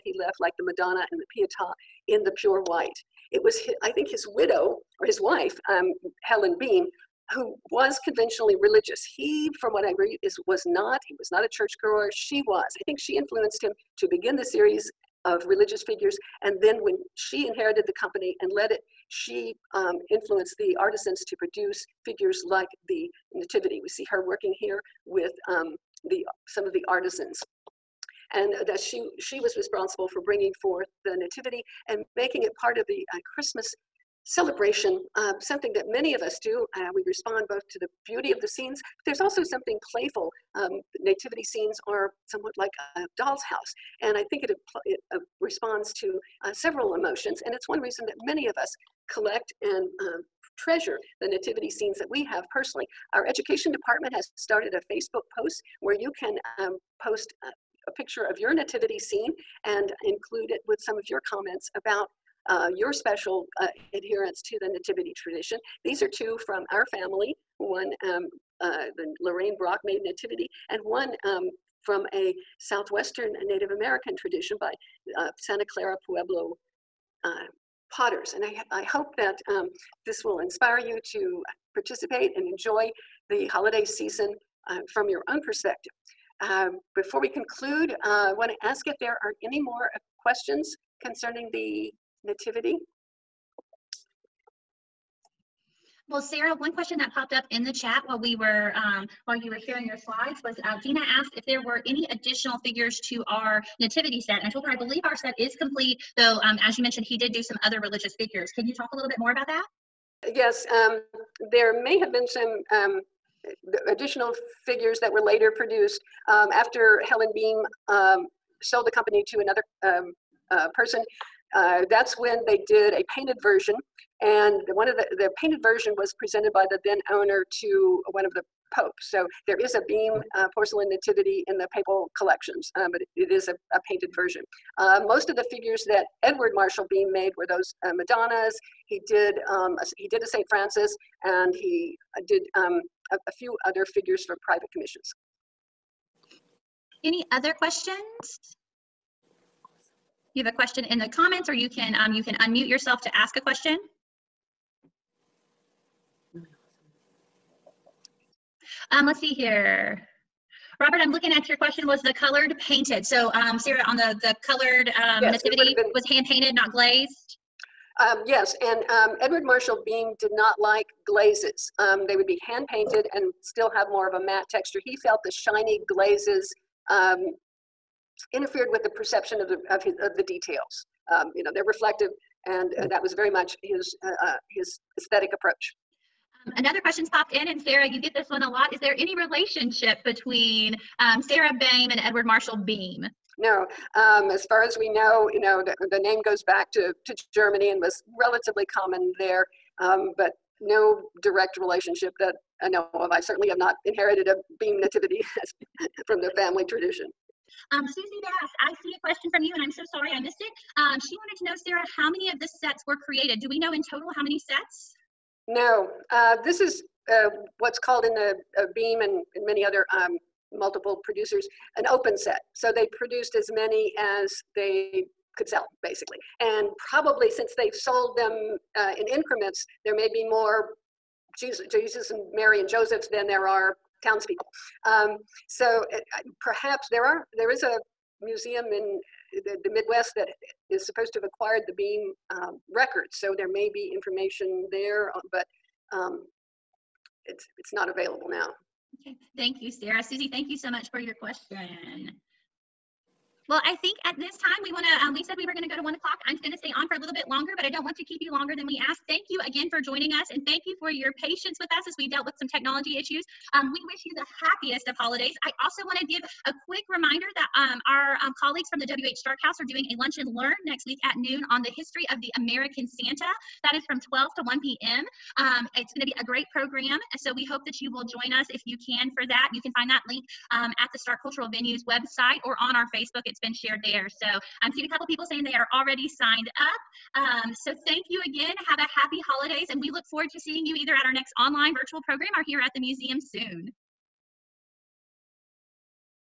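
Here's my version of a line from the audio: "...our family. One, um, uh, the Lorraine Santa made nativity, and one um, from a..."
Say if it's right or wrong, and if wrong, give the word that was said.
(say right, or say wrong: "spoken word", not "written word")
wrong: "Brock", not "Santa".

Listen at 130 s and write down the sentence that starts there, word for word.
uh, porcelain nativity in the papal collections, um, but it is a, a painted version.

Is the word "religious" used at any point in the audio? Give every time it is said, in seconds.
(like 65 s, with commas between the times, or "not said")
8 s, 15 s, 107 s.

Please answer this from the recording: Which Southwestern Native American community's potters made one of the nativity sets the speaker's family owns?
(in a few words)
Santa Clara Pueblo.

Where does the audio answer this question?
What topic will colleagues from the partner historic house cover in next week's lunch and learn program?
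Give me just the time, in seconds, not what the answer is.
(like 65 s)
271 s.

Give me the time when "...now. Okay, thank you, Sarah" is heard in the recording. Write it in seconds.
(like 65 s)
248 s.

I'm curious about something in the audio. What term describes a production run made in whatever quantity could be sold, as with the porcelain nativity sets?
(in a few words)
open set.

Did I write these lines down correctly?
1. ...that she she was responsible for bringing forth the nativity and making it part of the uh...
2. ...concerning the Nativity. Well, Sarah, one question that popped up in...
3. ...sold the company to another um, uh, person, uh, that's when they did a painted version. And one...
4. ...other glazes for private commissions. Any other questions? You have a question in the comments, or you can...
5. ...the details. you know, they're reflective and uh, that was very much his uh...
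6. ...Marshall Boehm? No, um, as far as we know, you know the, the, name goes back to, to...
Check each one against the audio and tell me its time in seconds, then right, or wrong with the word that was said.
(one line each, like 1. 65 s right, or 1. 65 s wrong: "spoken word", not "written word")
1. 28 s right
2. 91 s right
3. 118 s right
4. 143 s wrong: "figures", not "glazes"
5. 180 s right
6. 192 s right.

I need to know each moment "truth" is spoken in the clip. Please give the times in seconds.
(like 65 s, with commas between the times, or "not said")
not said.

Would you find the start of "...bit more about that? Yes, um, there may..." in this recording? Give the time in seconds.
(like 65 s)
109 s.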